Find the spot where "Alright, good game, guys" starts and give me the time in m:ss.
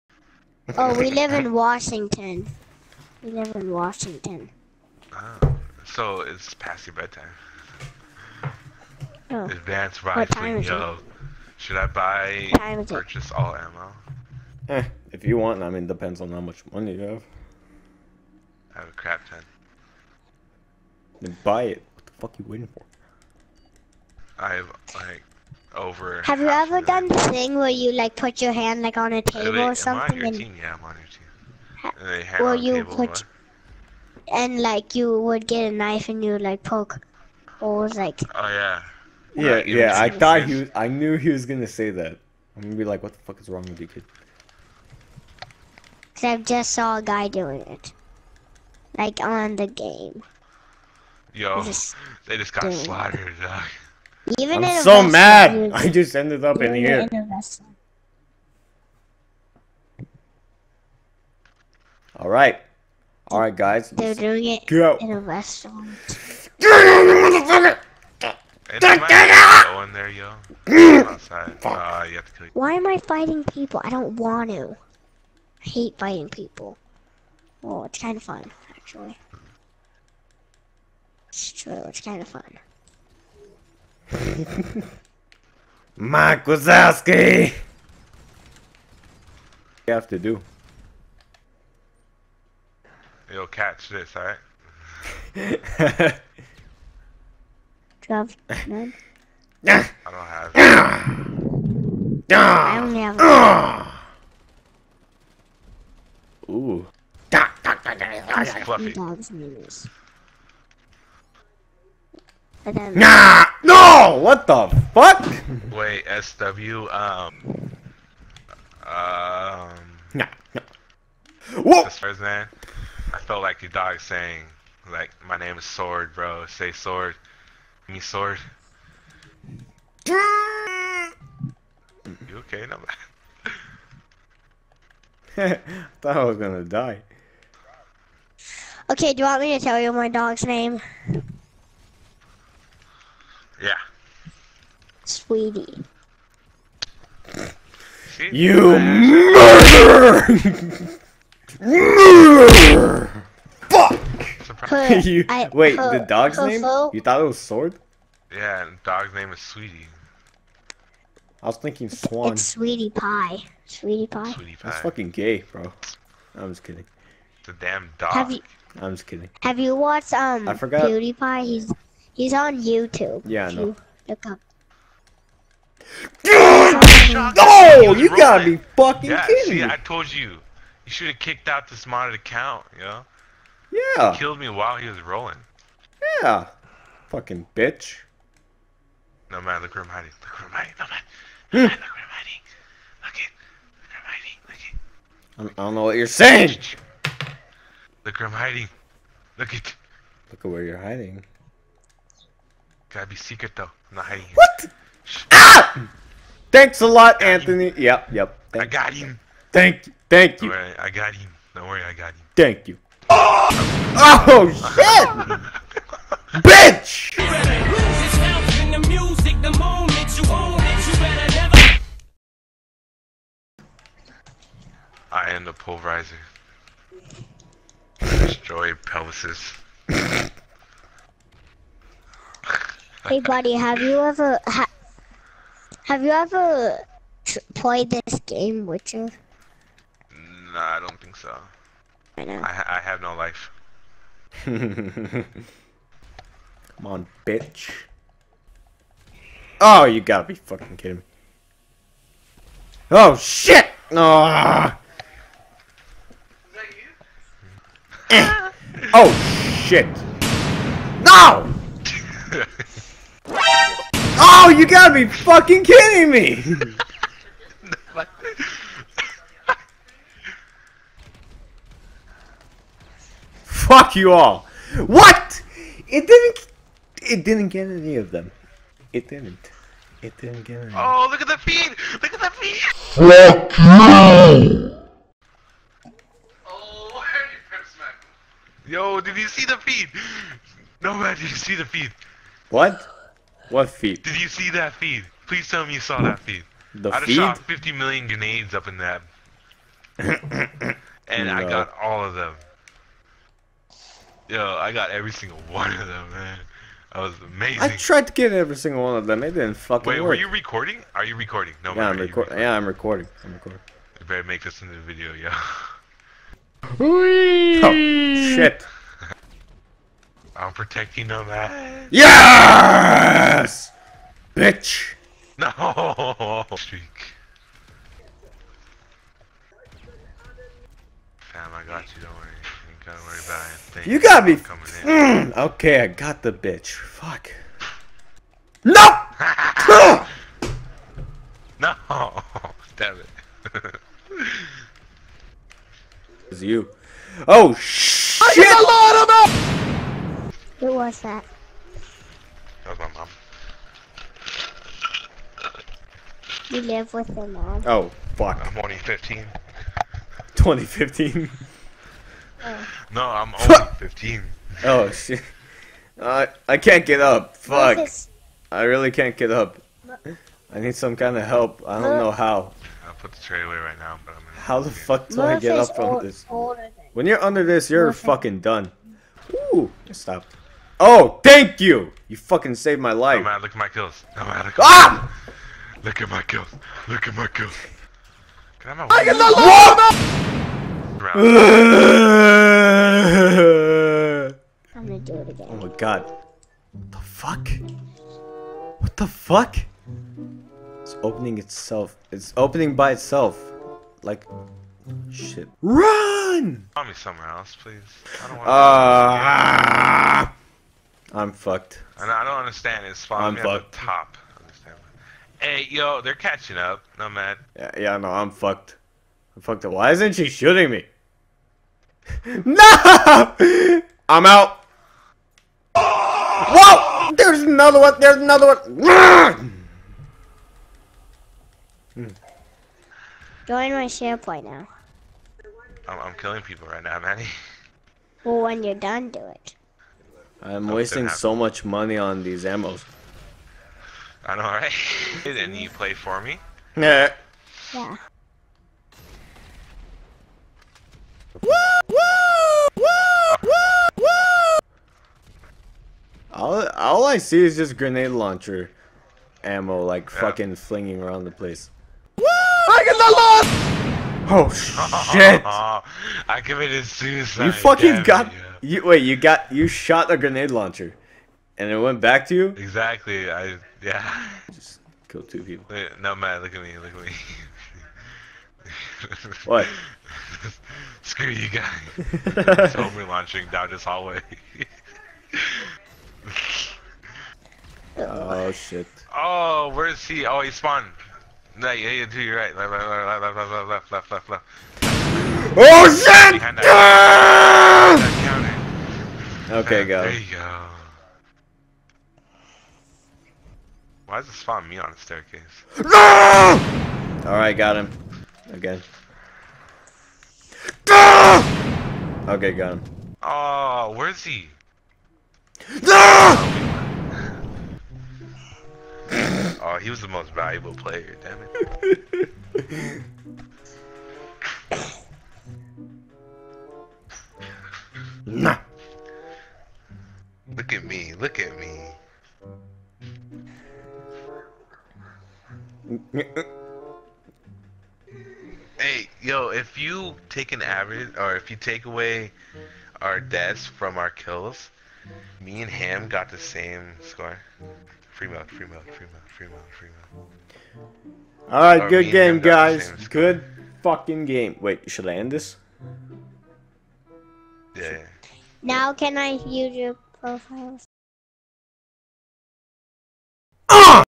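9:11.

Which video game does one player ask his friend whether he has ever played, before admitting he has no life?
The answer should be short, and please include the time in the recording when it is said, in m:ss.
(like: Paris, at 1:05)
Witcher, at 3:58.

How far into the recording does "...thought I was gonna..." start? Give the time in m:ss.
2:16.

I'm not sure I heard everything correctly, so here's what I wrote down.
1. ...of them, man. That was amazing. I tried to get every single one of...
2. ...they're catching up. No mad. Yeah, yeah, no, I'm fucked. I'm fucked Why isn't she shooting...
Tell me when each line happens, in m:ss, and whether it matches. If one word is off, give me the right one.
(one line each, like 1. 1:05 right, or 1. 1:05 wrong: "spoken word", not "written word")
1. 5:05 right
2. 6:56 right.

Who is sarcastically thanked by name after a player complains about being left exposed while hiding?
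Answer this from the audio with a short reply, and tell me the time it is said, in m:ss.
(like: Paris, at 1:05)
Anthony, at 3:27.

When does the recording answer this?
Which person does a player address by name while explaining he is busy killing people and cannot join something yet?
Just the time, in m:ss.
7:16.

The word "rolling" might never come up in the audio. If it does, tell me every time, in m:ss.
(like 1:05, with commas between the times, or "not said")
3:05.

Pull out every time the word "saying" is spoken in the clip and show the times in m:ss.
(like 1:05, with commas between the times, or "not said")
2:03, 3:16.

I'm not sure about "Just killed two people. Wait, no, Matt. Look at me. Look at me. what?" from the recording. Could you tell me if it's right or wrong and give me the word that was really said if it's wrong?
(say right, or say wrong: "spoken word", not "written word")
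right.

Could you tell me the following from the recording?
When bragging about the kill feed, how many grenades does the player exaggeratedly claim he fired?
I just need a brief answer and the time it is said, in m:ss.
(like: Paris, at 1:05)
50 million, at 4:57.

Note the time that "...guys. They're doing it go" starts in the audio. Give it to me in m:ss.
1:03.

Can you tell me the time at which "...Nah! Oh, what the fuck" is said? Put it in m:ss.
1:52.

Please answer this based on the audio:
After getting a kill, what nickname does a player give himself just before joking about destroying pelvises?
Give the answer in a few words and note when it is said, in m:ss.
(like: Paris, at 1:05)
the pulverizer, at 3:45.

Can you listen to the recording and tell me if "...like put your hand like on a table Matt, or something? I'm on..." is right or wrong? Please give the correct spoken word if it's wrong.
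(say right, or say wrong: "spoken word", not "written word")
wrong: "Wait", not "Matt".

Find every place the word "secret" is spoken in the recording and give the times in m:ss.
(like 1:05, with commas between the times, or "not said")
3:23.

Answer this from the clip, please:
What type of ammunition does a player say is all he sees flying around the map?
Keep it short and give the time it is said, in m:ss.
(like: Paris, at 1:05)
grenade launcher ammo, at 7:37.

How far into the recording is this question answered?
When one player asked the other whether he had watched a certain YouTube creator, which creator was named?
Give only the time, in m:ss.
2:50.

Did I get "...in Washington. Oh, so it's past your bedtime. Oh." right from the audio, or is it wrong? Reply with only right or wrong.
right.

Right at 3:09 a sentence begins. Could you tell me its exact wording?
No man, look where I'm hiding.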